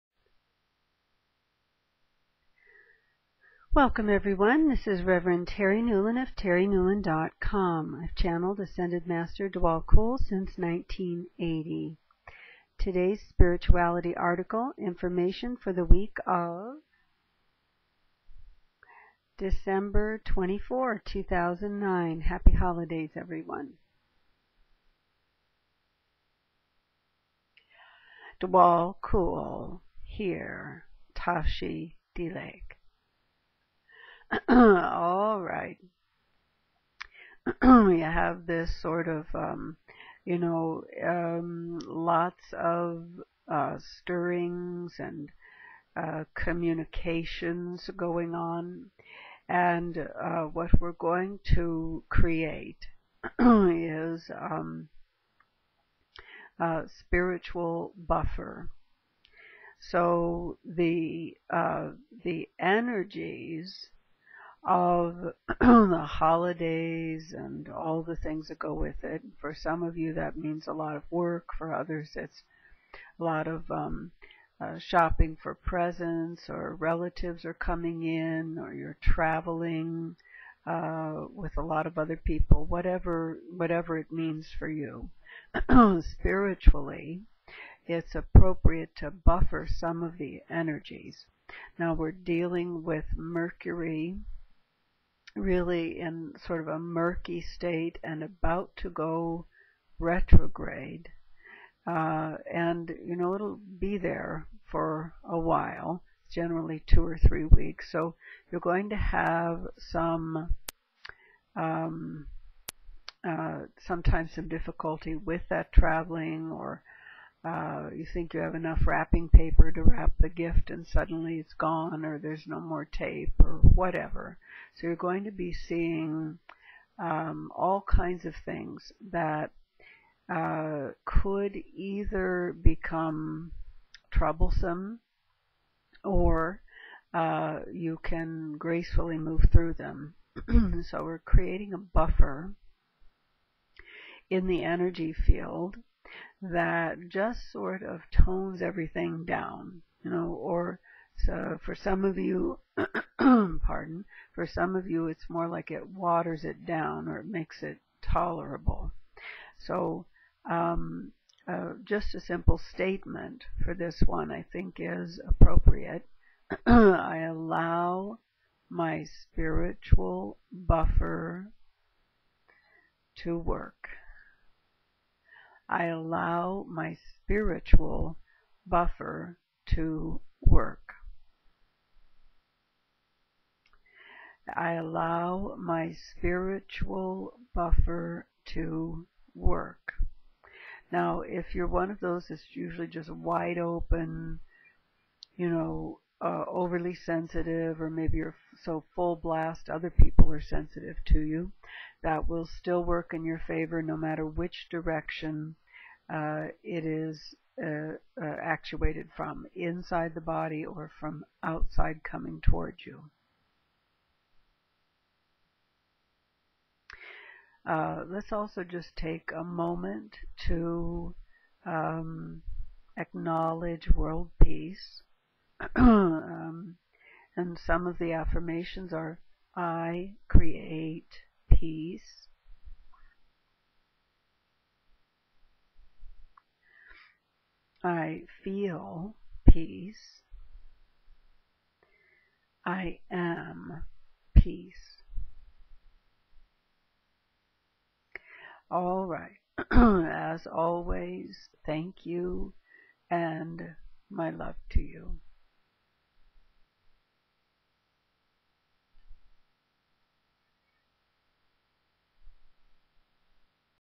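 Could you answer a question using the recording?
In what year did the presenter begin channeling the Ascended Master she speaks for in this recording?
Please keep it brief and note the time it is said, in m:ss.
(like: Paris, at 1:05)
1980, at 0:10.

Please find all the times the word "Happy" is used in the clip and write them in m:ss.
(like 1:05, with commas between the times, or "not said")
0:22.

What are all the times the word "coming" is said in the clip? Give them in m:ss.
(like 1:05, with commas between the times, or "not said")
1:17, 3:32.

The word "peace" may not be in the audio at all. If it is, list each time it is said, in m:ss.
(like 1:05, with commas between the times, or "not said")
3:44, 3:51, 3:59, 4:04.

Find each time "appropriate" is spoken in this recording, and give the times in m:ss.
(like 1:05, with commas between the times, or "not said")
1:28, 2:45.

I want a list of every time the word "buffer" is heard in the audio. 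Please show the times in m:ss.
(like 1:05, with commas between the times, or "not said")
0:57, 1:29, 2:21, 2:50, 2:58, 3:07.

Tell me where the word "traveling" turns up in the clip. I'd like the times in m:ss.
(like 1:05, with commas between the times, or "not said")
1:19, 1:55.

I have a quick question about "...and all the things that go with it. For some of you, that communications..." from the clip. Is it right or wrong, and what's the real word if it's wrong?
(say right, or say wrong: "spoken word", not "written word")
wrong: "means", not "communications".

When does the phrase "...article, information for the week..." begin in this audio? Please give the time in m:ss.
0:14.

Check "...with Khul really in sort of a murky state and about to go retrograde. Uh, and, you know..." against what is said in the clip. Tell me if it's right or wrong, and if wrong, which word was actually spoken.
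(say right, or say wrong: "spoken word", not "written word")
wrong: "Mercury", not "Khul".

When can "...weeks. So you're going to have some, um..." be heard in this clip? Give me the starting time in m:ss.
1:47.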